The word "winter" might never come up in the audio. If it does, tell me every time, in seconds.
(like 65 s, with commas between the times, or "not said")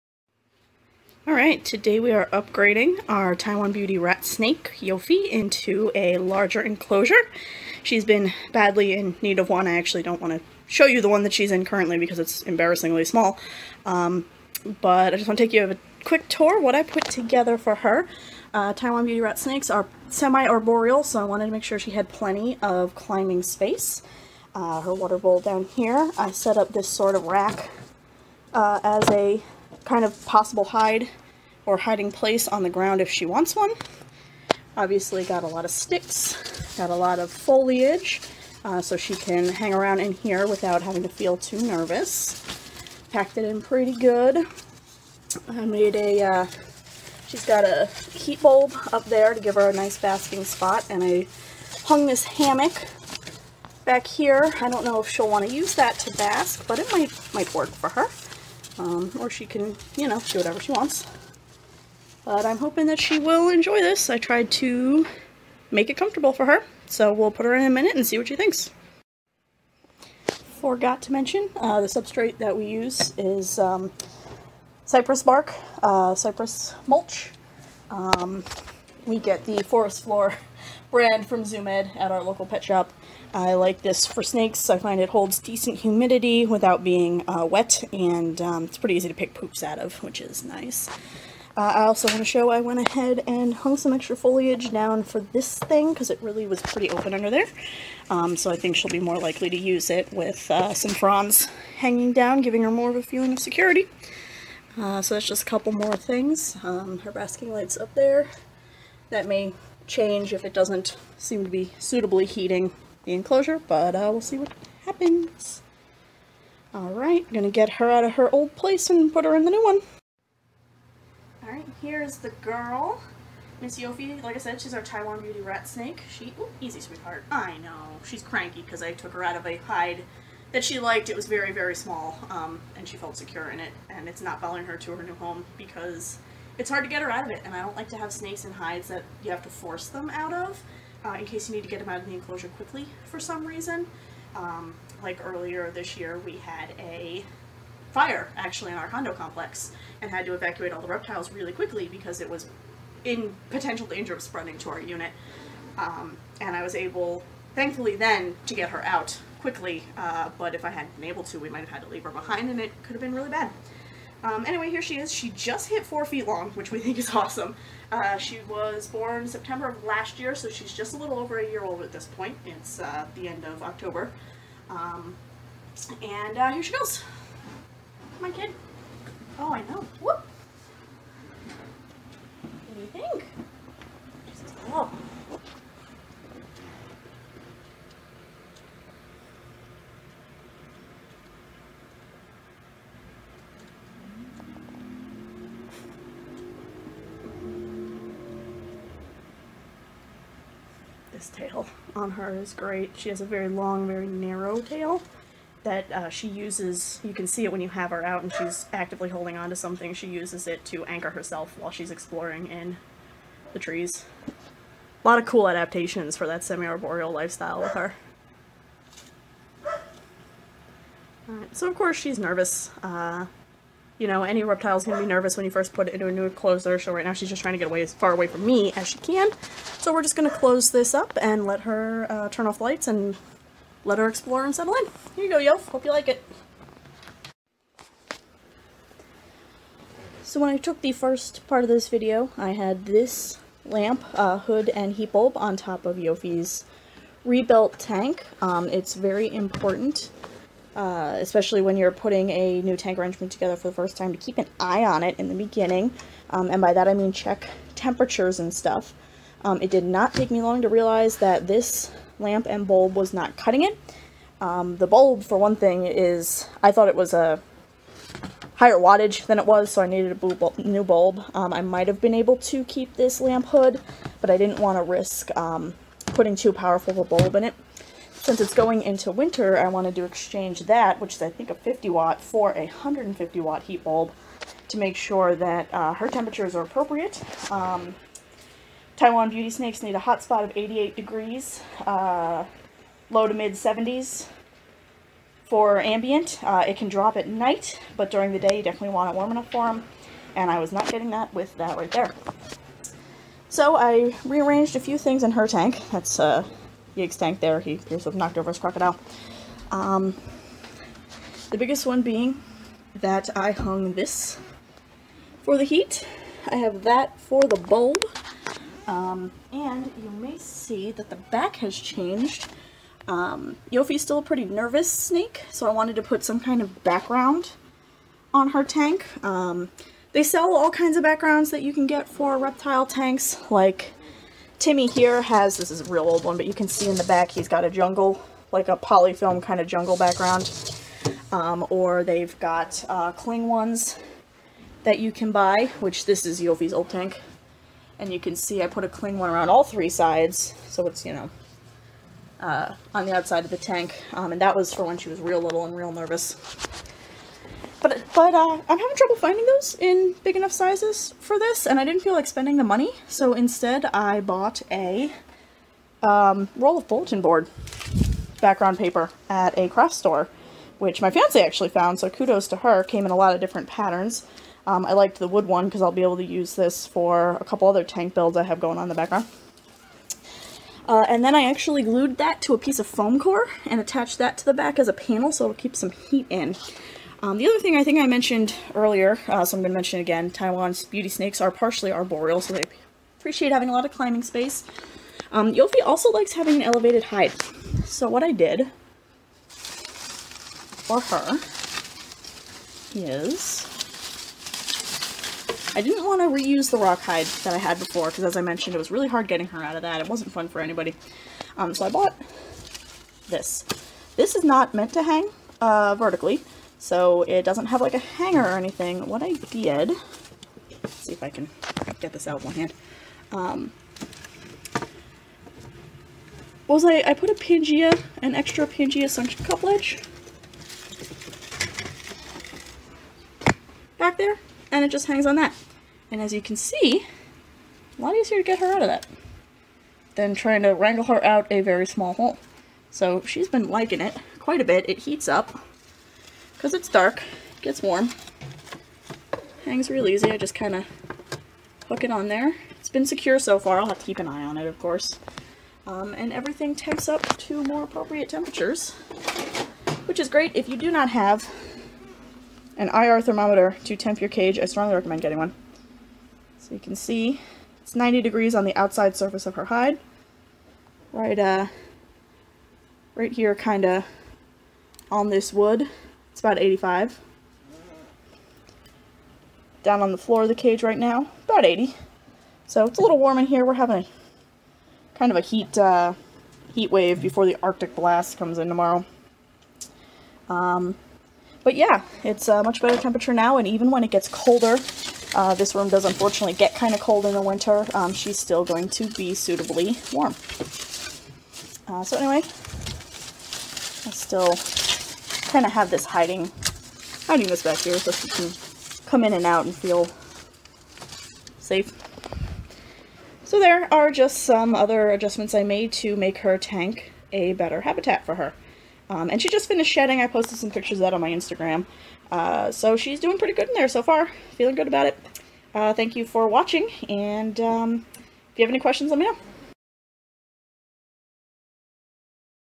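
279 s, 497 s.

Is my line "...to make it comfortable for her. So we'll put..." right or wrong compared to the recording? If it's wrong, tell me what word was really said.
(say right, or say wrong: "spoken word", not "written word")
right.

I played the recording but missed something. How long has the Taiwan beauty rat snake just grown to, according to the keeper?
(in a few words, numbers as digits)
4 feet.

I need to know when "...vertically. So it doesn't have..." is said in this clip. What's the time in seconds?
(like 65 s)
415 s.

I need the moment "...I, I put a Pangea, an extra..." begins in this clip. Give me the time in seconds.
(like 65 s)
426 s.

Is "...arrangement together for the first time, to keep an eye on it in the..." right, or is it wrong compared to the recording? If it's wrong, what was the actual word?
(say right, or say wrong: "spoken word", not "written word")
right.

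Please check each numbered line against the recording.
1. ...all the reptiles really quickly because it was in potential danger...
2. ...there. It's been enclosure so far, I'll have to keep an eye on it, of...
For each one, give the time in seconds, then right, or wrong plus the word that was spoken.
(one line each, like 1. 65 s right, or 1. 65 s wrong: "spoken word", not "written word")
1. 150 s right
2. 452 s wrong: "secure", not "enclosure".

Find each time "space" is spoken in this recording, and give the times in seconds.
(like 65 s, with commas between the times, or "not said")
23 s, 394 s.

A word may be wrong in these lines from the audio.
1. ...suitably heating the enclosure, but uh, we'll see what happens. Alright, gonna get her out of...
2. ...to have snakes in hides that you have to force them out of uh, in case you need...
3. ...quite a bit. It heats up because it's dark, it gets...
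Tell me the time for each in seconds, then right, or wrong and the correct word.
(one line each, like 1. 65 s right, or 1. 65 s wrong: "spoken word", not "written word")
1. 111 s right
2. 137 s right
3. 444 s right.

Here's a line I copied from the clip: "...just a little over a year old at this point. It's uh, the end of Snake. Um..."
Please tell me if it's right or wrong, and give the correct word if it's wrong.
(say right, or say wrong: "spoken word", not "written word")
wrong: "October", not "Snake".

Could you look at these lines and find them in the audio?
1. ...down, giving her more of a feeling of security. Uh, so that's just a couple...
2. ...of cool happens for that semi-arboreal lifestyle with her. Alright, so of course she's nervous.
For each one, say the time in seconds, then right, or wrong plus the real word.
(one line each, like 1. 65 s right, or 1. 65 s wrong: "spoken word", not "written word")
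1. 102 s right
2. 215 s wrong: "adaptations", not "happens".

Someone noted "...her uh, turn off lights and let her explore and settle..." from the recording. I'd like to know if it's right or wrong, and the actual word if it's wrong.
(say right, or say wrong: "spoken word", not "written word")
right.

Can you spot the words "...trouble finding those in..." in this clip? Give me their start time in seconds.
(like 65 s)
358 s.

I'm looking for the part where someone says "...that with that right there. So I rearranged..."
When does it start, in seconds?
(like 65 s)
301 s.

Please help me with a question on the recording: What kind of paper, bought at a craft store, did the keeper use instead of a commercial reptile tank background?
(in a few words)
bulletin board background paper.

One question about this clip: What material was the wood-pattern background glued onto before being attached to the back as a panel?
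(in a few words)
foam core.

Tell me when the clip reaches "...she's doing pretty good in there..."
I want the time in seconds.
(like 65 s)
522 s.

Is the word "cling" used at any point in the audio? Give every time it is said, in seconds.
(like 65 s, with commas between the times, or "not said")
343 s, 348 s.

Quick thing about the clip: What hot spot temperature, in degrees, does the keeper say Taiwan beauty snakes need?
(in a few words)
88 degrees.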